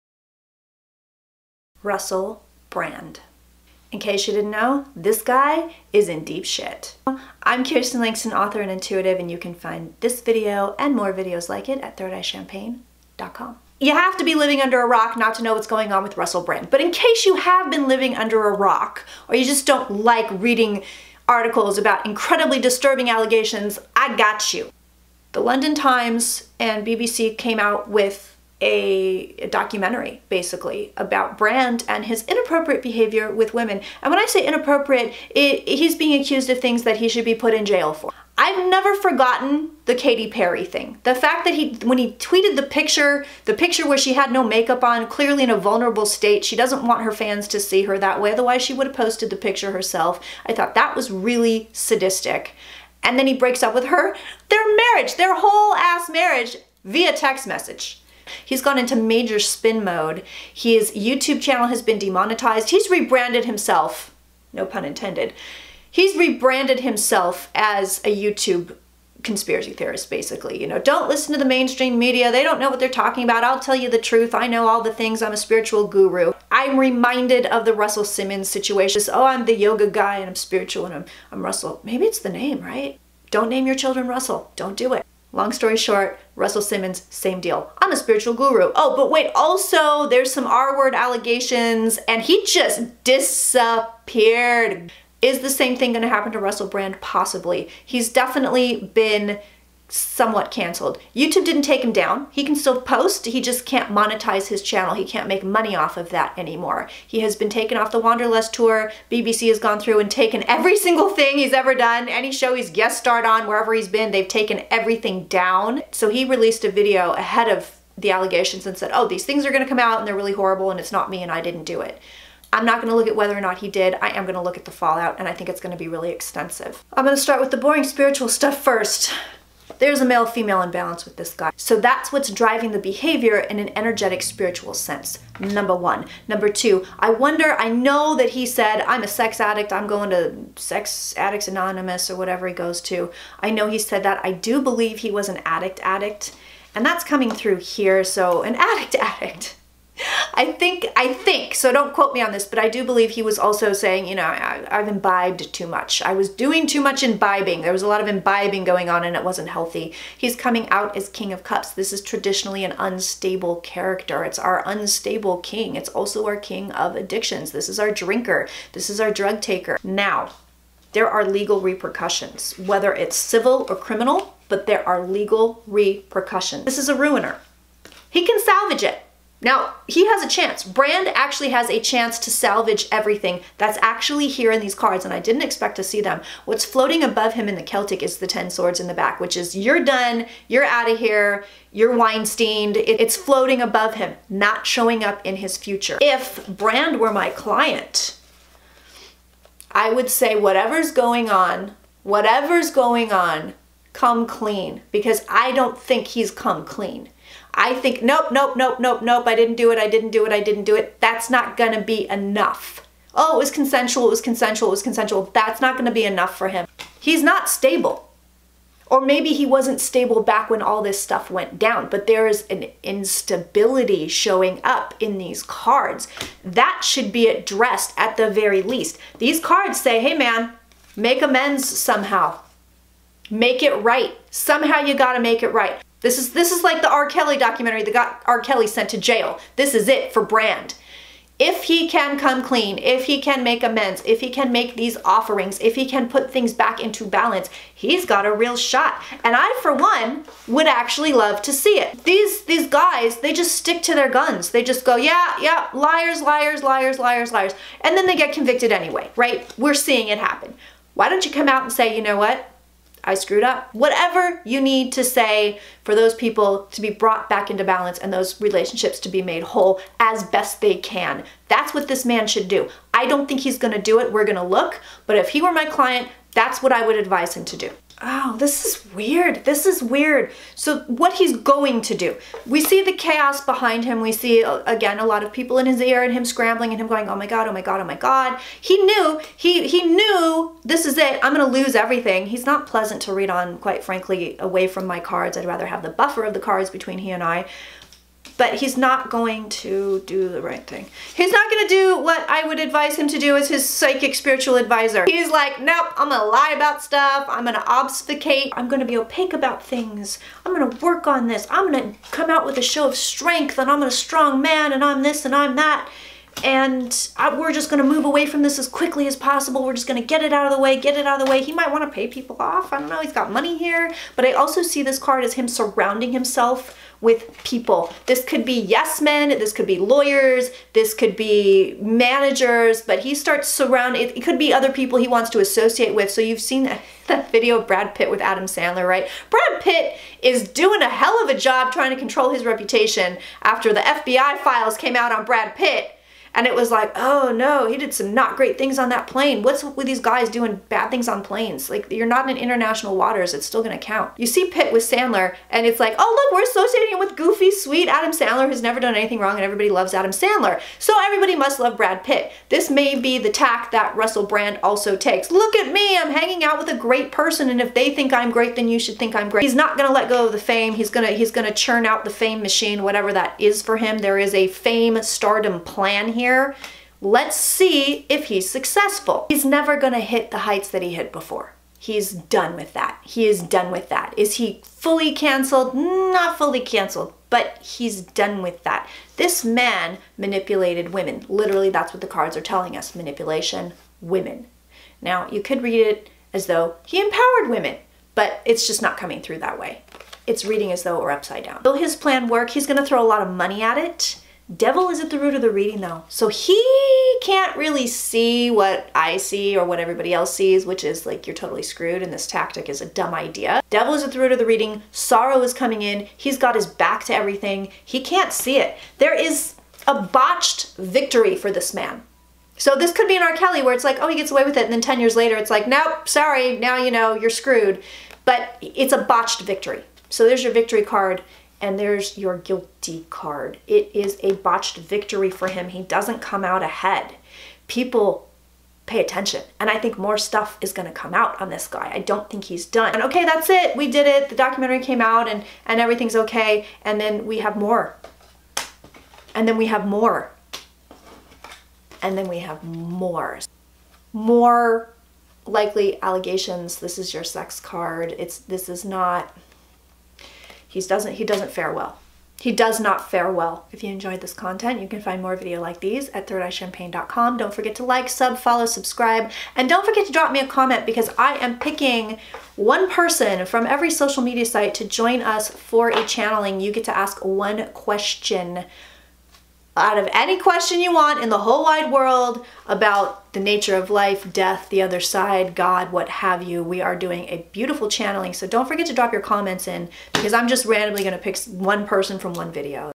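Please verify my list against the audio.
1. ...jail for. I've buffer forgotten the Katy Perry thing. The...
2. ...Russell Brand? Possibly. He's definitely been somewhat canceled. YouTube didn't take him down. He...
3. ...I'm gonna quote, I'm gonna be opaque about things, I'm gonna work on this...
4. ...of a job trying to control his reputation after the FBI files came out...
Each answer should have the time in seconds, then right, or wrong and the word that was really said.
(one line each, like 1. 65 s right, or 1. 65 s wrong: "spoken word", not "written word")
1. 37 s wrong: "never", not "buffer"
2. 96 s right
3. 307 s wrong: "obfuscate", not "quote"
4. 341 s right.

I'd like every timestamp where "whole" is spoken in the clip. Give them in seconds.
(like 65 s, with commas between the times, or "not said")
55 s, 269 s, 481 s.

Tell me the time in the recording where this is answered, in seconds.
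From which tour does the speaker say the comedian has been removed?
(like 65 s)
107 s.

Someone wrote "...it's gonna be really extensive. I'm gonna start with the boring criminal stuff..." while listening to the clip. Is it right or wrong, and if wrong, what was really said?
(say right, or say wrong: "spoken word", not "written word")
wrong: "spiritual", not "criminal".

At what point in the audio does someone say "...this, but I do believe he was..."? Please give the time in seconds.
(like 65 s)
152 s.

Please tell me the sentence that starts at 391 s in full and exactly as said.
Literally, that's what the cards are telling us manipulation, women.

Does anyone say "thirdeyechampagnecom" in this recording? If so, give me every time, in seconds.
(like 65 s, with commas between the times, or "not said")
11 s, 466 s.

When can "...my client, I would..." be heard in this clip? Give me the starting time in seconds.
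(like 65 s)
197 s.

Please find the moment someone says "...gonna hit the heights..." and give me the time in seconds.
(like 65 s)
379 s.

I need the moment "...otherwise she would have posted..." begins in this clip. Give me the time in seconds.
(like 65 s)
48 s.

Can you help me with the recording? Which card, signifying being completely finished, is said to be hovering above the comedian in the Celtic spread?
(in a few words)
10 swords.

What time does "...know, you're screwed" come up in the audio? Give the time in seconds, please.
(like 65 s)
426 s.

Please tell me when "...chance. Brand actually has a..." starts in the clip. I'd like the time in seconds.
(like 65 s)
180 s.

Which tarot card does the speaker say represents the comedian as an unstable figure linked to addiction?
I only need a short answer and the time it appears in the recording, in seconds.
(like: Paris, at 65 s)
King of Cups, at 161 s.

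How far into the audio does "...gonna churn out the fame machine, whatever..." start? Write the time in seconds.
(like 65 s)
371 s.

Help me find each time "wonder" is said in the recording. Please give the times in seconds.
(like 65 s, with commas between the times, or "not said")
137 s.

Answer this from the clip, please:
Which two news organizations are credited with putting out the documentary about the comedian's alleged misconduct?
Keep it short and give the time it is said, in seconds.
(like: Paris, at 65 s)
London Times and BBC, at 25 s.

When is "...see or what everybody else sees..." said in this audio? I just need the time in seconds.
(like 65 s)
409 s.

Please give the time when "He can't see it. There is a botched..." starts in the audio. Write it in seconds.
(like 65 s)
417 s.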